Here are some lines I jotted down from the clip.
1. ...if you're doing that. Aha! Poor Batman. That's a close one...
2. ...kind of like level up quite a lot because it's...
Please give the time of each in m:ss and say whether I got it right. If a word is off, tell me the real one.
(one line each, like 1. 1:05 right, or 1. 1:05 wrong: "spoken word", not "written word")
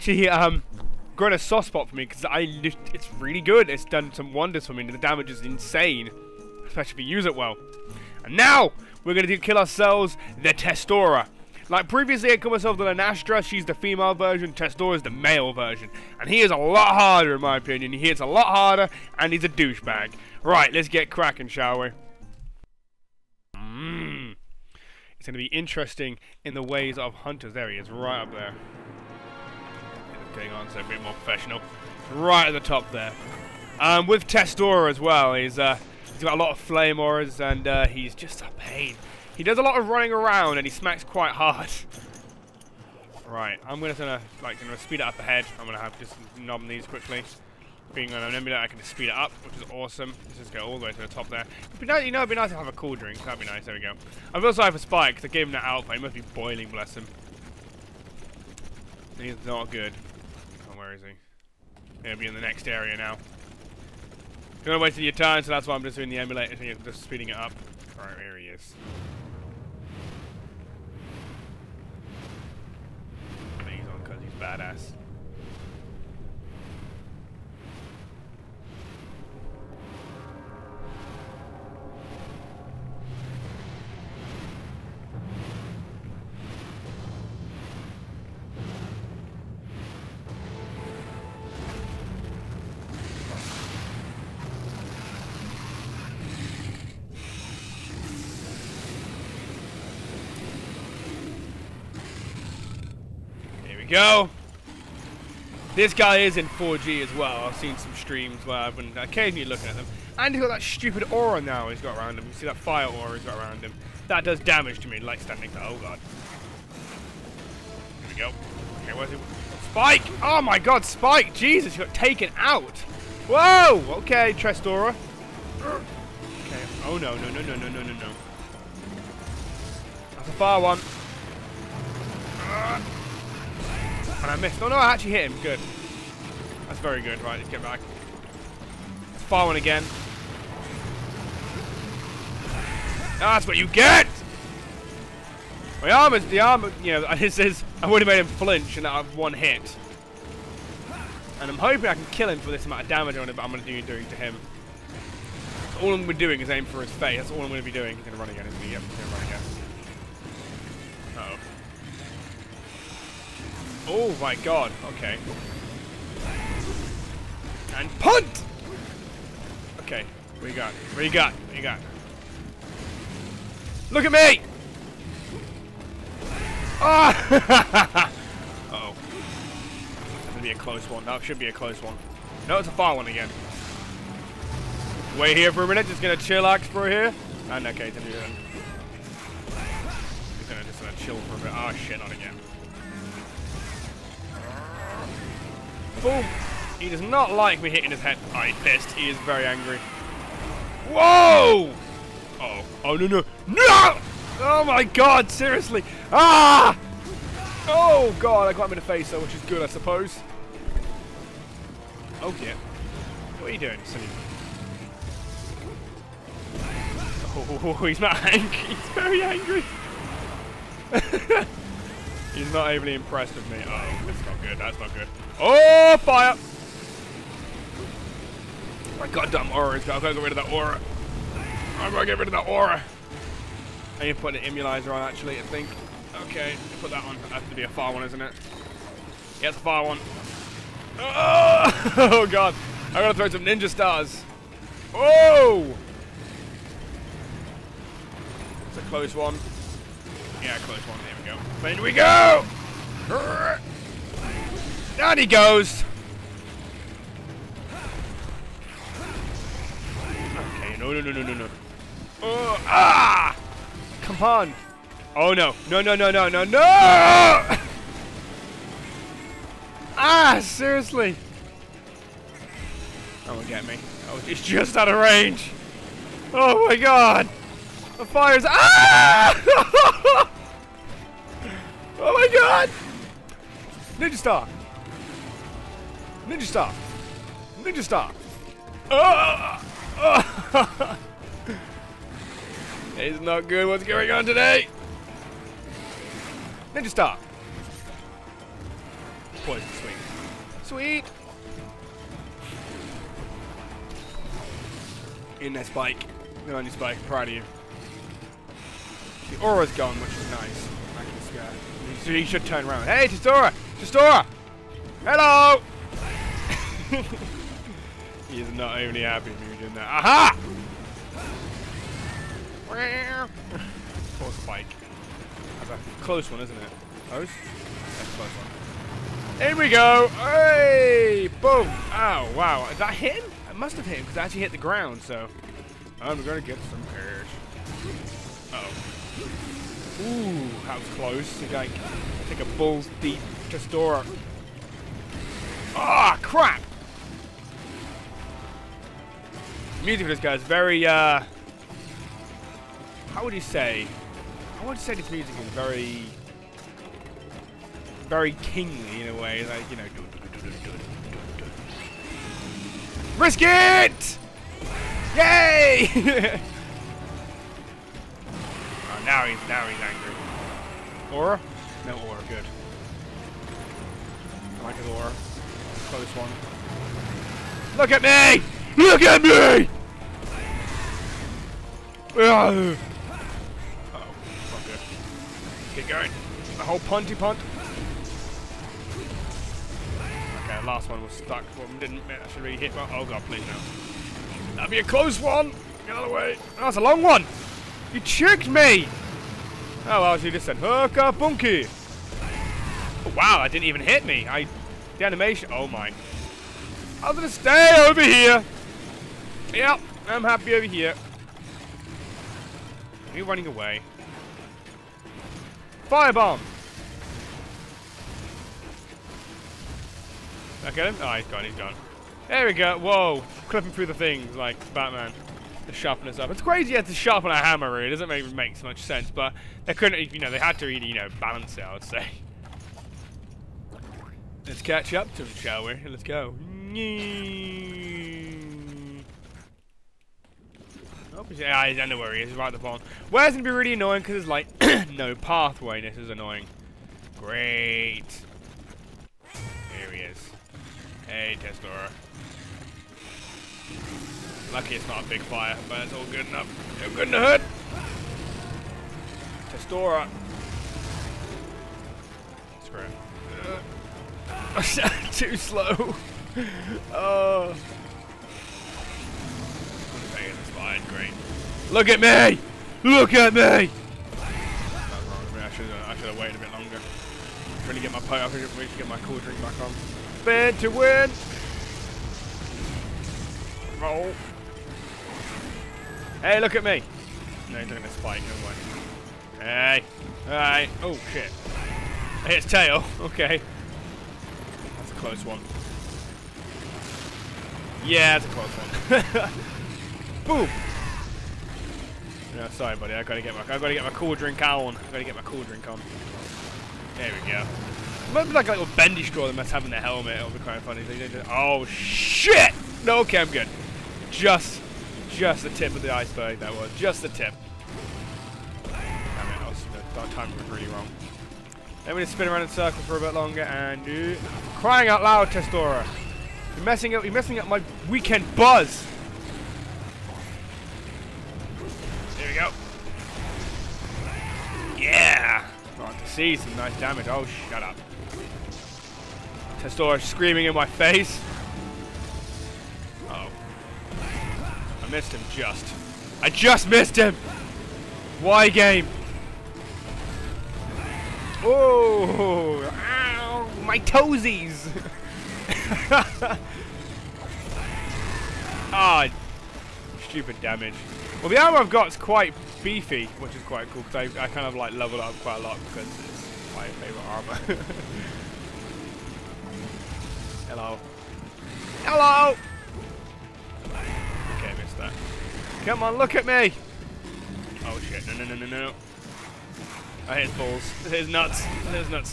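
1. 5:19 wrong: "Spike", not "Batman"
2. 9:24 right.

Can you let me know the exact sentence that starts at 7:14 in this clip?
Let's catch up to them, shall we?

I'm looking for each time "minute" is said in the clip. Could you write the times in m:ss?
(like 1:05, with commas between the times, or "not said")
3:05.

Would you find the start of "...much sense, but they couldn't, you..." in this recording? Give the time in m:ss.
7:08.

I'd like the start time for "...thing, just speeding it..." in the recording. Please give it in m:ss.
1:06.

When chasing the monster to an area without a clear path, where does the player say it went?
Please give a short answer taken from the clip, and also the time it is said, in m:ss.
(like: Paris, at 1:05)
The pond, at 7:22.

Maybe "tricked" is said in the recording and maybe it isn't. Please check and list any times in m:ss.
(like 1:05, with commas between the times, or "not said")
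6:38.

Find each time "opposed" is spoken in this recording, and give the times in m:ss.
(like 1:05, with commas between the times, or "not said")
not said.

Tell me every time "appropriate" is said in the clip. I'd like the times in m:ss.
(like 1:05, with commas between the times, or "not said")
not said.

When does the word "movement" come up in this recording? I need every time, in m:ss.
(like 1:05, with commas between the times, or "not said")
not said.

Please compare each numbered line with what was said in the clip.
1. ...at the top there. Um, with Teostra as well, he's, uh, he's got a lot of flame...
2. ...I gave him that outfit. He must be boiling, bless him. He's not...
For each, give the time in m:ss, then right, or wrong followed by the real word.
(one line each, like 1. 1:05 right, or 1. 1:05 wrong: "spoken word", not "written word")
1. 0:32 right
2. 0:55 right.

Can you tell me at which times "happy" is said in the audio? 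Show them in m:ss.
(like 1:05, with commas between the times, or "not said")
5:19, 6:50.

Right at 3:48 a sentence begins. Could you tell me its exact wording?
My goddamn aura I've got to get rid of that aura.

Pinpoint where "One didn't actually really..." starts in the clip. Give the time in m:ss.
6:31.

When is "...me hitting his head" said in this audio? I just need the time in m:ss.
3:17.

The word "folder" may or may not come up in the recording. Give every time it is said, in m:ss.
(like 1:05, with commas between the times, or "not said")
not said.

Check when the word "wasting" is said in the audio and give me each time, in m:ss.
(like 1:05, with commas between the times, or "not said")
1:04.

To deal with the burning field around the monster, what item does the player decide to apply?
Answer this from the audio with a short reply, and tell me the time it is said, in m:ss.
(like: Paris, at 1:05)
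Immunizer, at 3:54.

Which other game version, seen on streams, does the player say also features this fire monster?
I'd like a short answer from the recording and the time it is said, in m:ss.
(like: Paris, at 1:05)
4G, at 1:46.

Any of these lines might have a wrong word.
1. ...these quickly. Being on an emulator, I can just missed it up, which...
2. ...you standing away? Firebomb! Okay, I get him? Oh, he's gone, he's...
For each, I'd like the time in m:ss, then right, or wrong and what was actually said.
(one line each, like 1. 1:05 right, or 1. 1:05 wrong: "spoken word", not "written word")
1. 0:46 wrong: "speed", not "missed"
2. 6:53 wrong: "running", not "standing".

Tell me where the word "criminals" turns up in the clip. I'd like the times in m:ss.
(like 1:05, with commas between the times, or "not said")
not said.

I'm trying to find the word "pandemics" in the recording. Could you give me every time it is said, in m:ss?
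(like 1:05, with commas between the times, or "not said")
not said.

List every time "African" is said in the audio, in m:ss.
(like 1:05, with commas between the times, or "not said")
not said.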